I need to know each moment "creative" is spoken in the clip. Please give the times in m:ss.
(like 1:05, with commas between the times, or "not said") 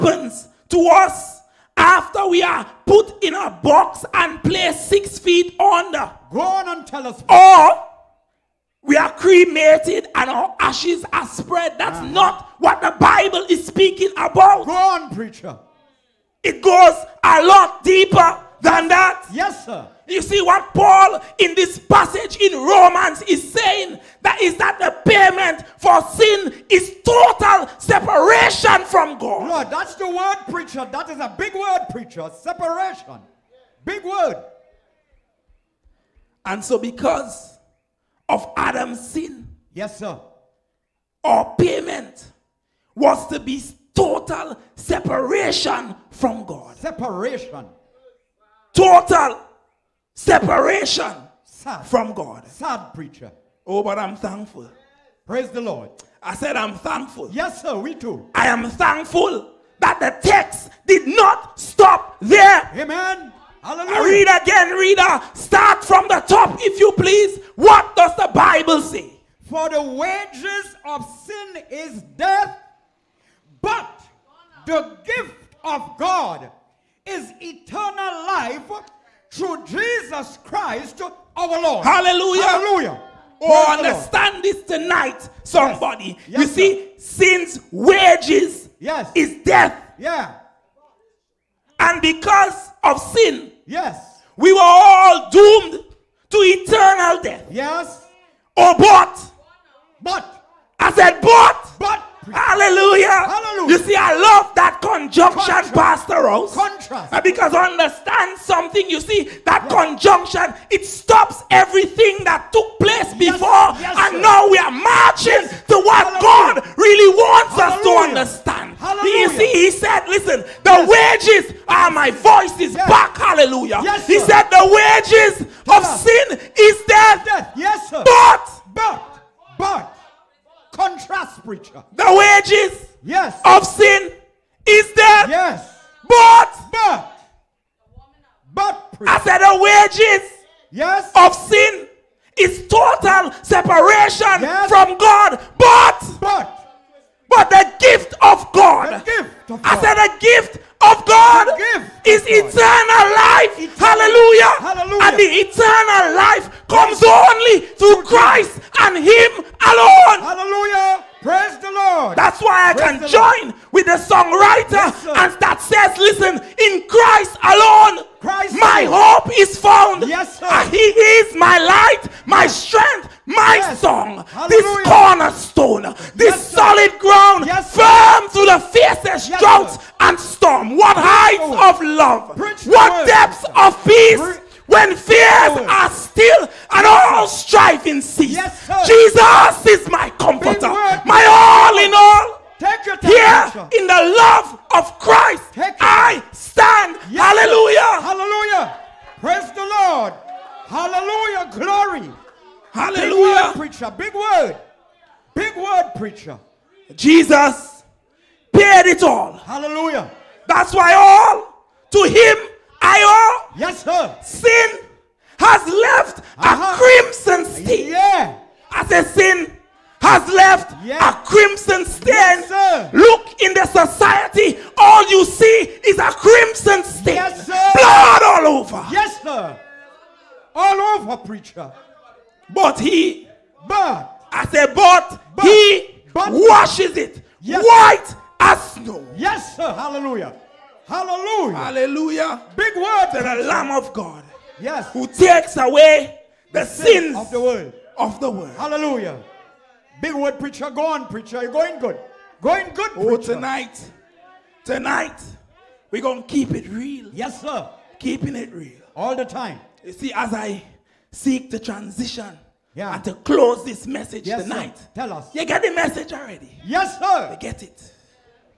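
not said.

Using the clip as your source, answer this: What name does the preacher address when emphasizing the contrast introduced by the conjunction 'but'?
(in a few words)
Pastor Rose.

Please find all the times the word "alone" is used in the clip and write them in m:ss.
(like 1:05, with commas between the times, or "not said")
2:39, 2:47.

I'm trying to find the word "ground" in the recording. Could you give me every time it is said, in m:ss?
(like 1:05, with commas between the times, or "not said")
2:57.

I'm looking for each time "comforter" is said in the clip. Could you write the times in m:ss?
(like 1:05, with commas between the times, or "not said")
3:10.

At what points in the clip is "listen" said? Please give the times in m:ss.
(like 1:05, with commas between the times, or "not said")
2:00, 2:45.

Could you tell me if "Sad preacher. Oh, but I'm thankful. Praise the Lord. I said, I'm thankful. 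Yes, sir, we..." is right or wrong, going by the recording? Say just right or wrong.
right.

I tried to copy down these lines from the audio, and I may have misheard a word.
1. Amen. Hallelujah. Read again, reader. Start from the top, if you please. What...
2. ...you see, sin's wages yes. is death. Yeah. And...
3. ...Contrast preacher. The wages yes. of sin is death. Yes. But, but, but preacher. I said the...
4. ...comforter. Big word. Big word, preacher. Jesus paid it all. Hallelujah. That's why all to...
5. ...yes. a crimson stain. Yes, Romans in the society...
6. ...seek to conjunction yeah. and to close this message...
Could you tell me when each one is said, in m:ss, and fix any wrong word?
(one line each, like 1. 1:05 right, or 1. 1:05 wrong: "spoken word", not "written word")
1. 1:02 right
2. 1:26 right
3. 2:10 right
4. 3:23 wrong: "preacher", not "comforter"
5. 3:40 wrong: "Look", not "Romans"
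6. 4:21 wrong: "transition", not "conjunction".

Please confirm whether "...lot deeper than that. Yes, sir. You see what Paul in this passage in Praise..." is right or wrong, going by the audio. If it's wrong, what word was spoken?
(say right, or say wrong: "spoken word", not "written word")
wrong: "Romans", not "Praise".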